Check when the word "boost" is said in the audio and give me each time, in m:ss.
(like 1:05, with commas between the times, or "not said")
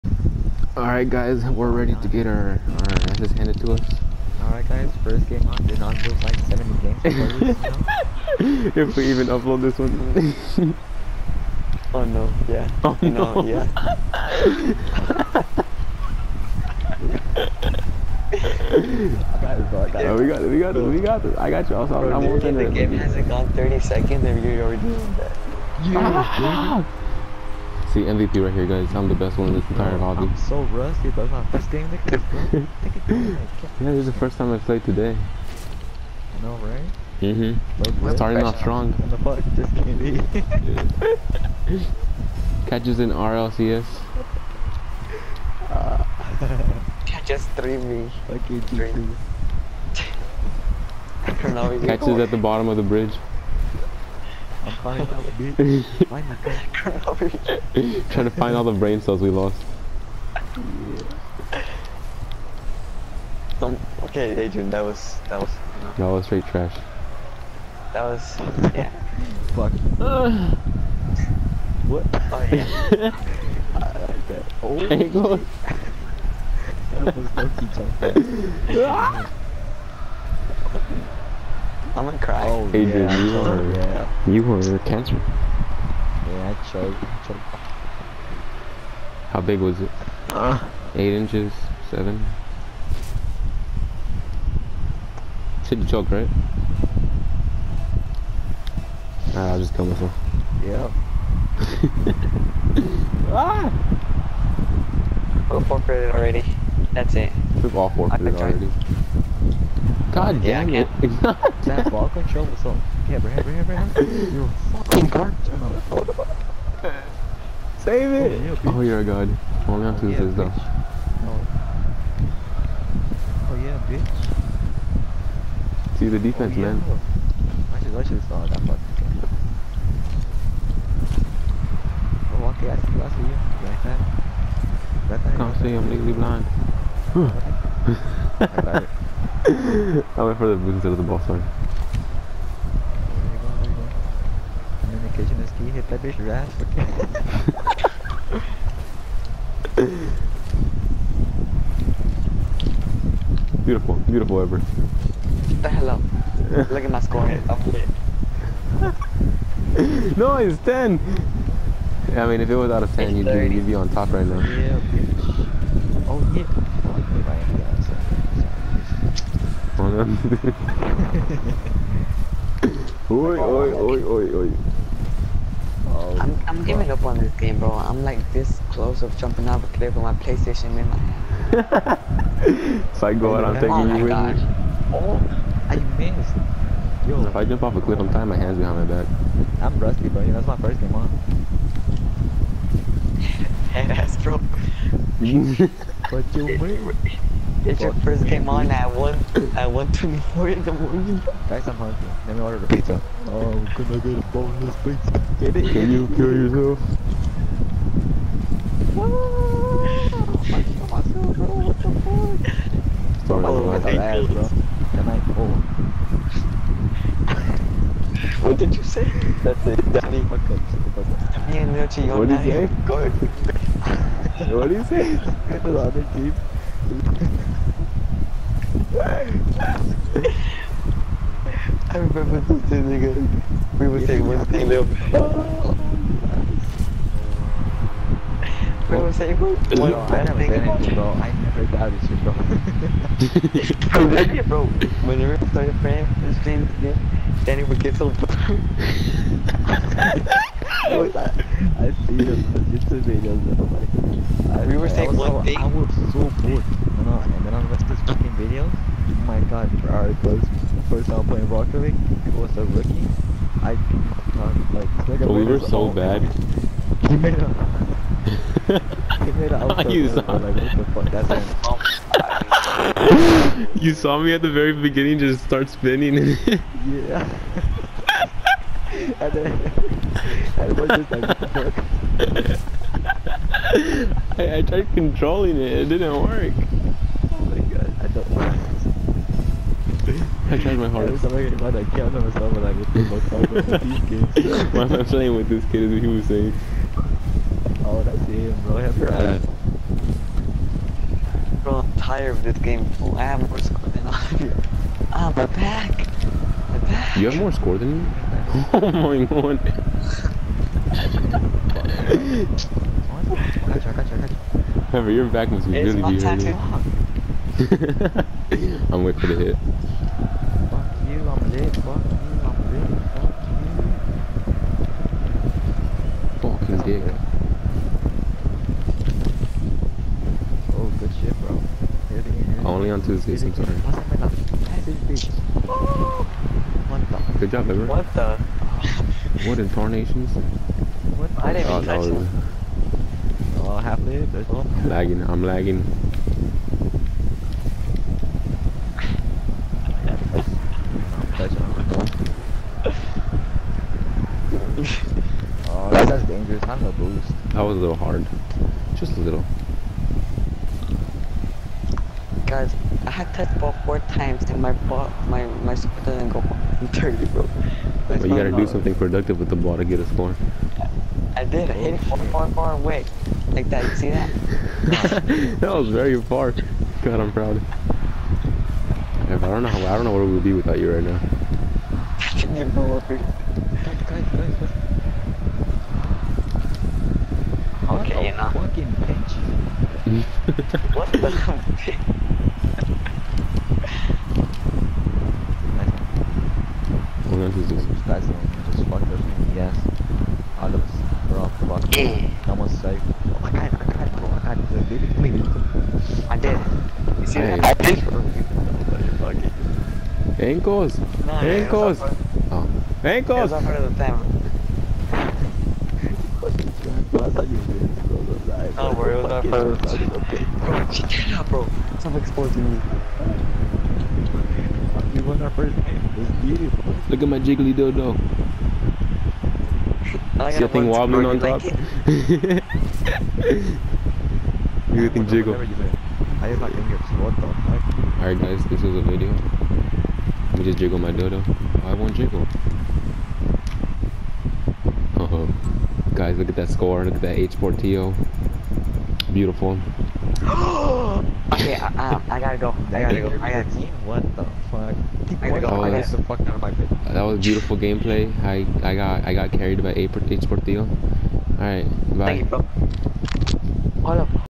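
2:20, 5:56.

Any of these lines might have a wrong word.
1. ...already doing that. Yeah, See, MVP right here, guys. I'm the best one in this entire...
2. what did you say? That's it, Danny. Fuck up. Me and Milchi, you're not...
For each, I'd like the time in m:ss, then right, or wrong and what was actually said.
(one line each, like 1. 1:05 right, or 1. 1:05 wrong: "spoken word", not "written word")
1. 0:24 right
2. 3:38 right.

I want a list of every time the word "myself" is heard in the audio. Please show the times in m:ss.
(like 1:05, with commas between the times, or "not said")
1:39, 4:51.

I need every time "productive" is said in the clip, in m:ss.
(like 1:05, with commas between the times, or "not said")
6:08.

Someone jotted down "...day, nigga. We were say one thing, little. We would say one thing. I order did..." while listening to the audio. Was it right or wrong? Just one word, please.
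wrong.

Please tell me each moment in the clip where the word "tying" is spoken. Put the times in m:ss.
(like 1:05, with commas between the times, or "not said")
3:08.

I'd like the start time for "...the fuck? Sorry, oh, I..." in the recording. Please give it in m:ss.
3:31.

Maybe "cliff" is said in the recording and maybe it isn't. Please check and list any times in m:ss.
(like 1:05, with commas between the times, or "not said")
2:59, 3:07.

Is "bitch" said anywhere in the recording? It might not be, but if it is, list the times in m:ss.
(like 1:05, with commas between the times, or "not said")
2:03, 2:26, 2:44, 6:29.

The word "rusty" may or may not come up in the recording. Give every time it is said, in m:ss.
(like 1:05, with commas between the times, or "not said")
0:30, 3:09.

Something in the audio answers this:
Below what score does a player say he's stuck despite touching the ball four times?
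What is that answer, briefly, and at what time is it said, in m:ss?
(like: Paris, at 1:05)
130, at 6:06.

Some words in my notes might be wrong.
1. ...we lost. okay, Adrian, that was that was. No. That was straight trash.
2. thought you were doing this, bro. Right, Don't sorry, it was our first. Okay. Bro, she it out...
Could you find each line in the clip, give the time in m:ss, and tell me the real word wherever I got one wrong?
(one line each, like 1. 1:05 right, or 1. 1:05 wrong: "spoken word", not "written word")
1. 0:59 right
2. 6:57 wrong: "worry", not "sorry".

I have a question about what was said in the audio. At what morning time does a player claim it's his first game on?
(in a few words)
1:24.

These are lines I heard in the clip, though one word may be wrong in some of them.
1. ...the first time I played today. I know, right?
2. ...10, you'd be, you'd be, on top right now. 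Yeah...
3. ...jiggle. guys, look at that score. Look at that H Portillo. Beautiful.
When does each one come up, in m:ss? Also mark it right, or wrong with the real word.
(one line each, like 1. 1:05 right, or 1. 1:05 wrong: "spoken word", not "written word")
1. 0:34 right
2. 2:42 right
3. 7:22 right.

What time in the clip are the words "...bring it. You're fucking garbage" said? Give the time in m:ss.
1:53.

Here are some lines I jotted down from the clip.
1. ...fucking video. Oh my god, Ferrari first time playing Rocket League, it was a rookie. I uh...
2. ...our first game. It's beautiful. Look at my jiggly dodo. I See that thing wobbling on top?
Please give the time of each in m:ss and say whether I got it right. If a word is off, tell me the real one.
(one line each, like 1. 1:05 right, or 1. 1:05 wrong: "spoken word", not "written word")
1. 4:18 right
2. 7:05 right.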